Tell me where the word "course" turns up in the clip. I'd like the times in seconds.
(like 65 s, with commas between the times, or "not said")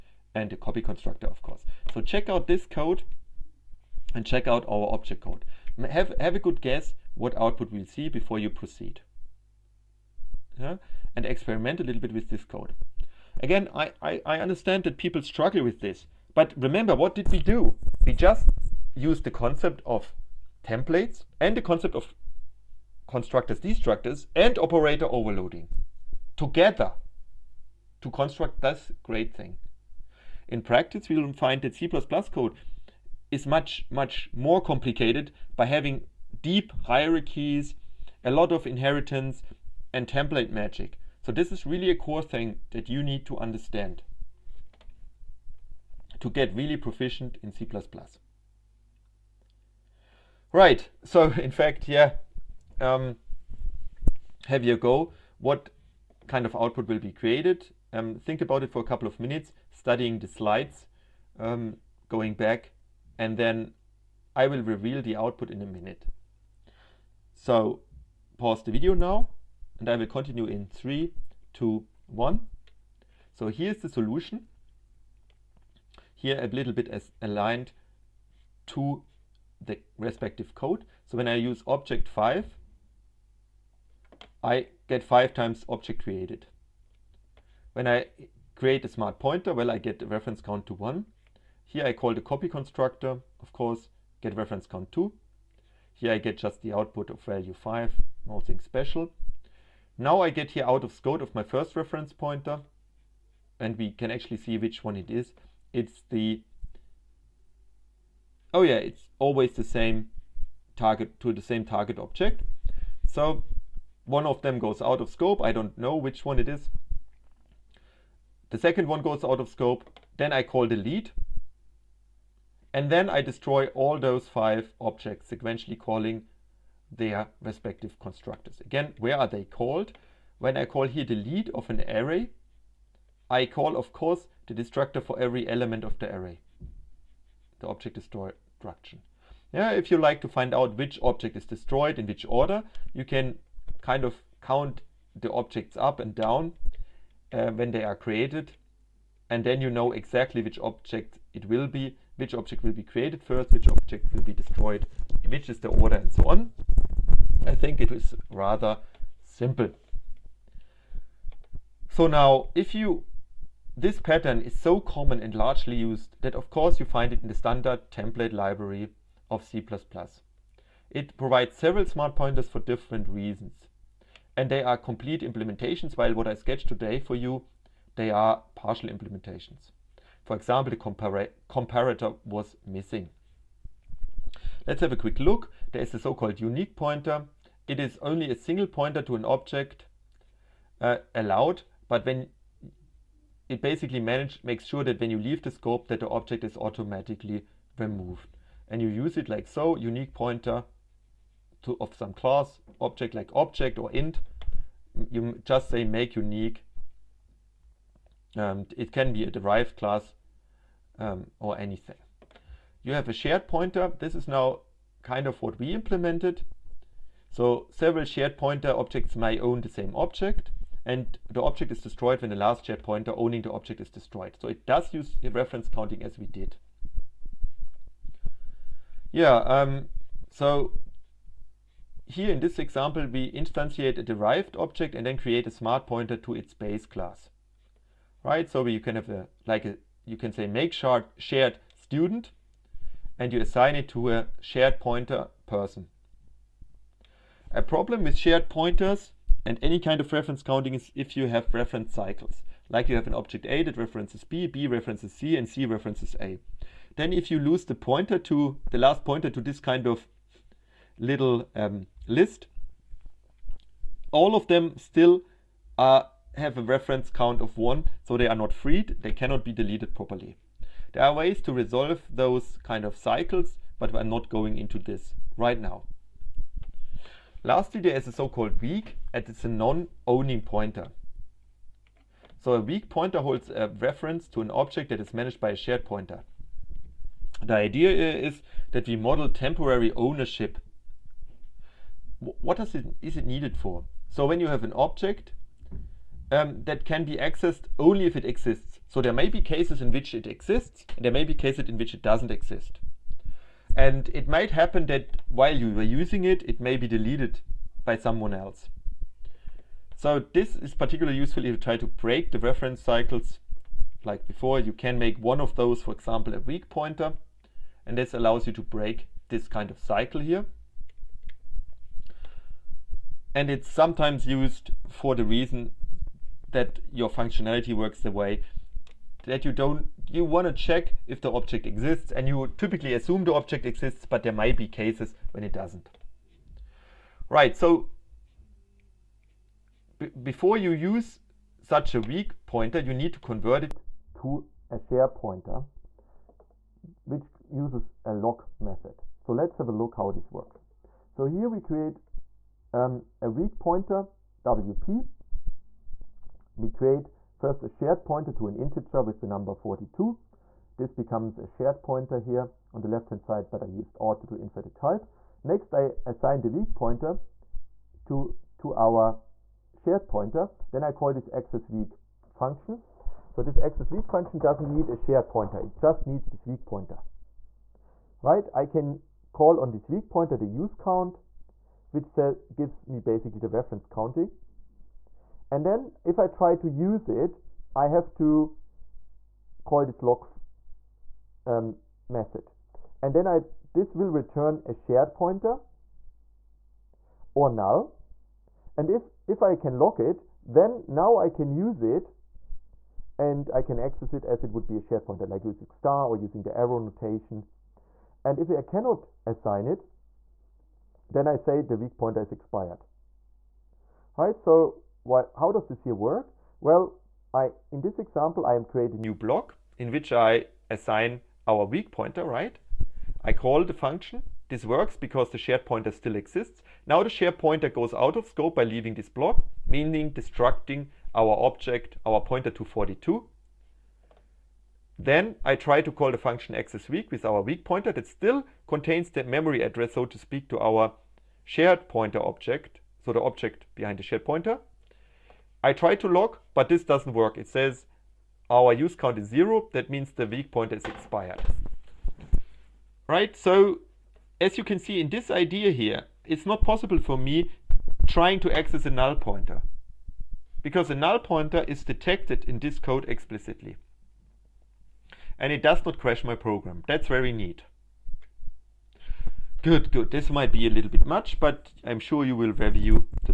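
1 s, 93 s, 133 s, 166 s.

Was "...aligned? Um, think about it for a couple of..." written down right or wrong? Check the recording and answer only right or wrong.
wrong.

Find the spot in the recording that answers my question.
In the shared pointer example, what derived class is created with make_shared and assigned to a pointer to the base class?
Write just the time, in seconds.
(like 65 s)
241 s.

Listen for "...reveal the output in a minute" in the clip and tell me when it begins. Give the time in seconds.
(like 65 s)
64 s.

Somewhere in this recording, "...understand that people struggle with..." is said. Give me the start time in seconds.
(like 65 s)
14 s.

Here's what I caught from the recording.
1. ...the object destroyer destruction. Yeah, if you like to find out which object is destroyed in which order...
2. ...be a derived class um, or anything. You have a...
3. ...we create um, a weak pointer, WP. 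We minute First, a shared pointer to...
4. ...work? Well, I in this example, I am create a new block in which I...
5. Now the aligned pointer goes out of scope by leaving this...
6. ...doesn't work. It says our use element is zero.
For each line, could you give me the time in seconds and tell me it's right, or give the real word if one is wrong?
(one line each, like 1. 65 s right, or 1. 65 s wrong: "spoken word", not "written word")
1. 137 s right
2. 209 s right
3. 351 s wrong: "create", not "minute"
4. 415 s right
5. 426 s wrong: "shared", not "aligned"
6. 446 s wrong: "count", not "element".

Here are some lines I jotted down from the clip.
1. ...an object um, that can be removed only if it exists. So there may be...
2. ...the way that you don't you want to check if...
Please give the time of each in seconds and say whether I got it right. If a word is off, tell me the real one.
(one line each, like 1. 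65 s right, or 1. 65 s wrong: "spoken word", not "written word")
1. 294 s wrong: "accessed", not "removed"
2. 328 s right.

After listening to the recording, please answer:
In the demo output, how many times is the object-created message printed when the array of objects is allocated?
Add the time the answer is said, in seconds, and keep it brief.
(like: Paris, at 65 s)
5, at 85 s.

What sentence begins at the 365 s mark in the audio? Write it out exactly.
Next, I assign the weak pointer to, to our shared pointer.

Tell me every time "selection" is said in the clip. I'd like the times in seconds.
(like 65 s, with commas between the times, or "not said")
not said.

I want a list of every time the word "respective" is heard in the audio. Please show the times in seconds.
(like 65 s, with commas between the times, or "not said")
79 s, 127 s.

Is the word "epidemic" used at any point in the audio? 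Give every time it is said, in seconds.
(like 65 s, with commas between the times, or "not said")
not said.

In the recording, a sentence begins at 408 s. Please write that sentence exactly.
And if I cannot assign it, then I say the weak pointer is expired.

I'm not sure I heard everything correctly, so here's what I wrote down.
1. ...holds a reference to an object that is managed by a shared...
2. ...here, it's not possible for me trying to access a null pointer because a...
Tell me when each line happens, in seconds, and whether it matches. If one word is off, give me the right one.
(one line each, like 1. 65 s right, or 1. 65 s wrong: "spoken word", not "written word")
1. 283 s right
2. 455 s right.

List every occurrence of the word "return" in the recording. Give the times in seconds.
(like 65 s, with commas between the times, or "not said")
394 s.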